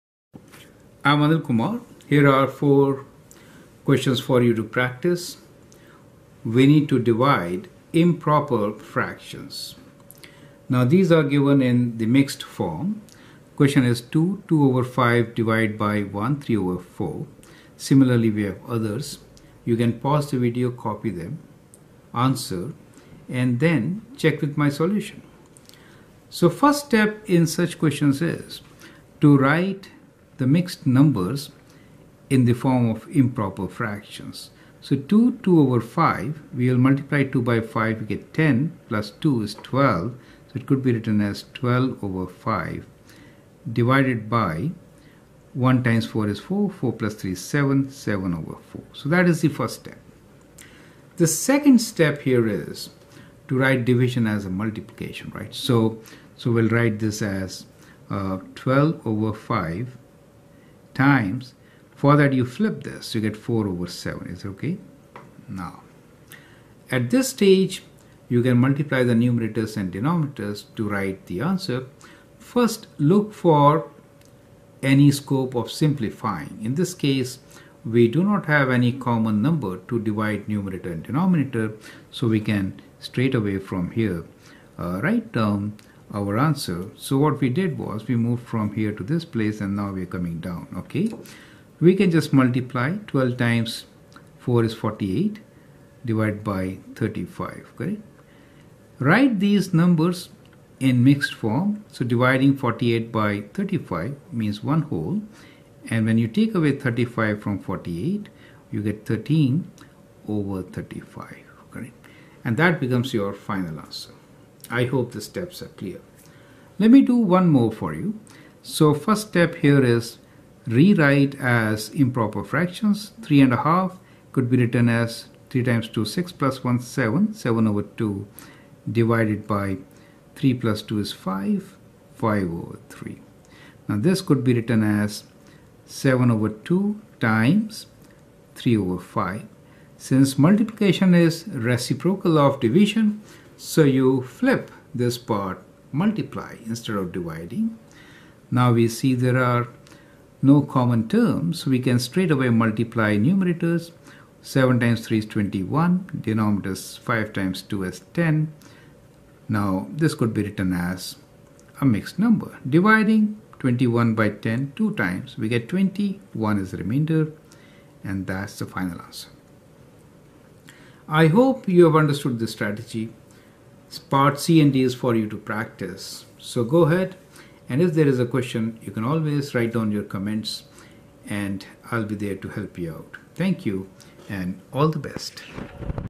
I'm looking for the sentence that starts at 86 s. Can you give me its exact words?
So what we did was we moved from here to this place and now we're coming down, okay?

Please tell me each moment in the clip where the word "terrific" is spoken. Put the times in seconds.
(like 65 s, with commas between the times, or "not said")
not said.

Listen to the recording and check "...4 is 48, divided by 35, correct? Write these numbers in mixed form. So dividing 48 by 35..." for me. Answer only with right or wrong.
right.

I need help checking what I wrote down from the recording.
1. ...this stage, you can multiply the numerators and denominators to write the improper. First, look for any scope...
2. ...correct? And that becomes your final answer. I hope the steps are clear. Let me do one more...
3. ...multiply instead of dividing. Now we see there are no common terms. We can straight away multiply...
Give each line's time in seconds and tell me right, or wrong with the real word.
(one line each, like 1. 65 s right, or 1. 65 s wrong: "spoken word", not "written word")
1. 67 s wrong: "answer", not "improper"
2. 111 s right
3. 145 s right.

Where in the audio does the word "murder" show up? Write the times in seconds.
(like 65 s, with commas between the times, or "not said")
not said.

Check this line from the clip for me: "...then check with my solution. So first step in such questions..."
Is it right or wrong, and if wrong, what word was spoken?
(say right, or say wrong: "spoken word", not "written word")
right.